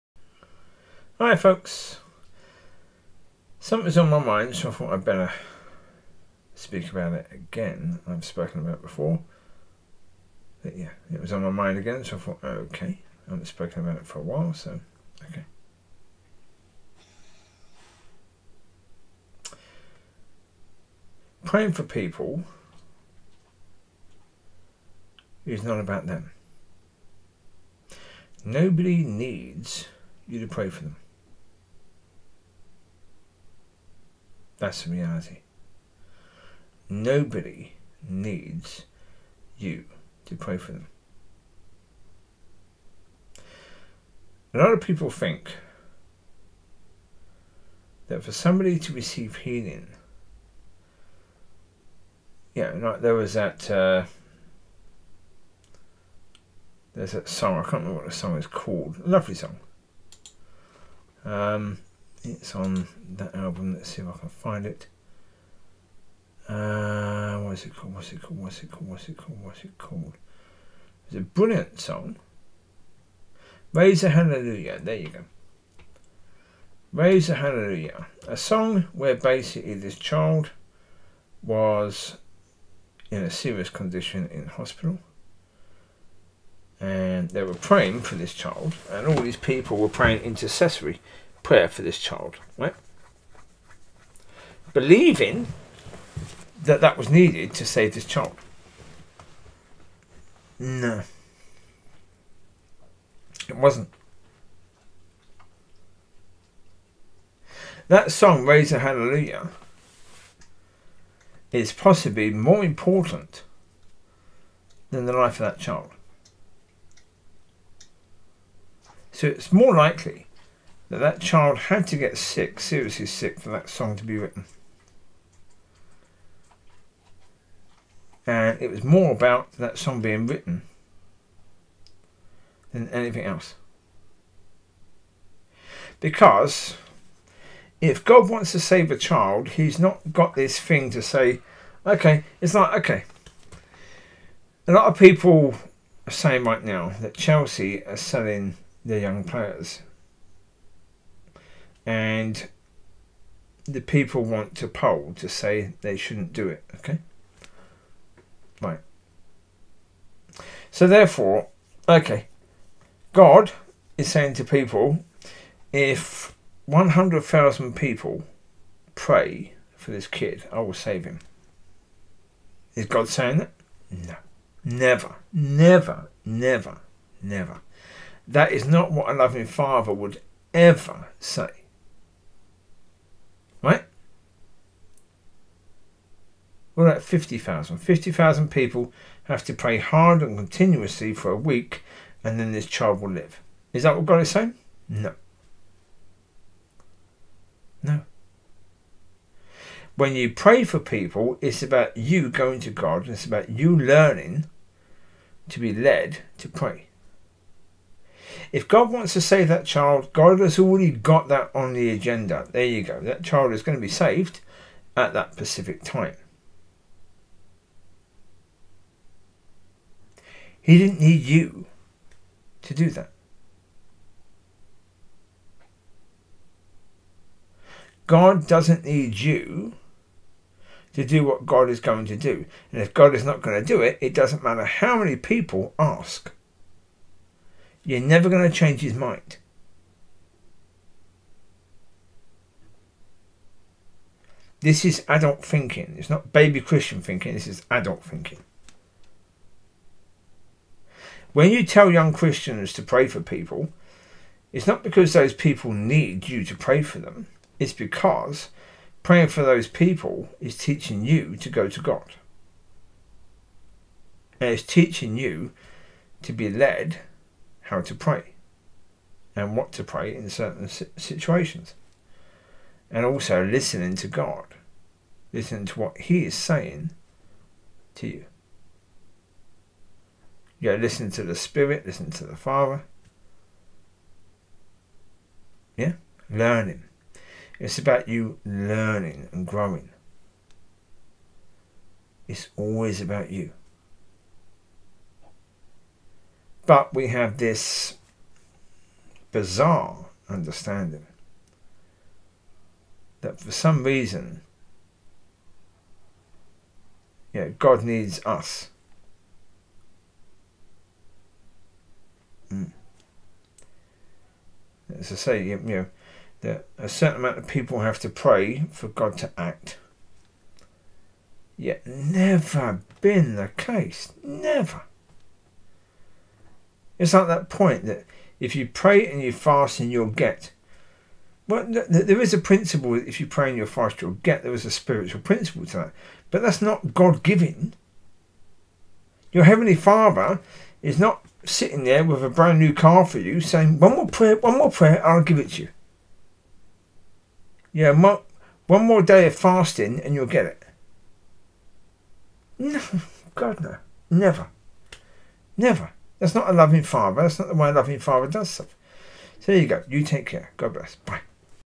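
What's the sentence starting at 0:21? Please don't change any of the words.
Praying for people is not about them.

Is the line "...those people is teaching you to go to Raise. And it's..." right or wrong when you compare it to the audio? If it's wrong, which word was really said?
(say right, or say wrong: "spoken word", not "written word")
wrong: "God", not "Raise".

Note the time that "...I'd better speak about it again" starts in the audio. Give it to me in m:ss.
0:04.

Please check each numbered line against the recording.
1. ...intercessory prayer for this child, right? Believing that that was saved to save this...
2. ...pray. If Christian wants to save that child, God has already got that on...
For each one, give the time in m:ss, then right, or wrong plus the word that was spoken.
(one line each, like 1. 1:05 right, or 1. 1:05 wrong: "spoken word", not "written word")
1. 1:30 wrong: "needed", not "saved"
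2. 3:26 wrong: "God", not "Christian".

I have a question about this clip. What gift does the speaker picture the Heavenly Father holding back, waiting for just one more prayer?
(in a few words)
brand new car.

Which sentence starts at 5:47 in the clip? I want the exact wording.
Yeah, one more day of fasting and you'll get it.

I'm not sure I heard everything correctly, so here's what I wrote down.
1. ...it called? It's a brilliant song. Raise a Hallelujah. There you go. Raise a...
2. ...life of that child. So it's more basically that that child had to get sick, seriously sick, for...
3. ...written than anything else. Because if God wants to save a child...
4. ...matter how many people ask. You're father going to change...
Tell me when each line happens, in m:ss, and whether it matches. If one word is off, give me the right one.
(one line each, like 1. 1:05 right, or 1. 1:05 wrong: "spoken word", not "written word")
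1. 1:09 right
2. 1:55 wrong: "likely", not "basically"
3. 2:10 right
4. 3:54 wrong: "never", not "father".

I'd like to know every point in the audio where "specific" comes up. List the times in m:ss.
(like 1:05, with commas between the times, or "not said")
3:35.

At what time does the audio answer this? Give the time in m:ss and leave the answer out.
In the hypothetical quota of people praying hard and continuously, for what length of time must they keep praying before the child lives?
3:11.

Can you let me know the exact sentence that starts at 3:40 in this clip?
He didn't need you to do that.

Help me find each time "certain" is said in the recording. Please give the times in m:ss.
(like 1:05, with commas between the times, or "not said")
4:30, 5:16.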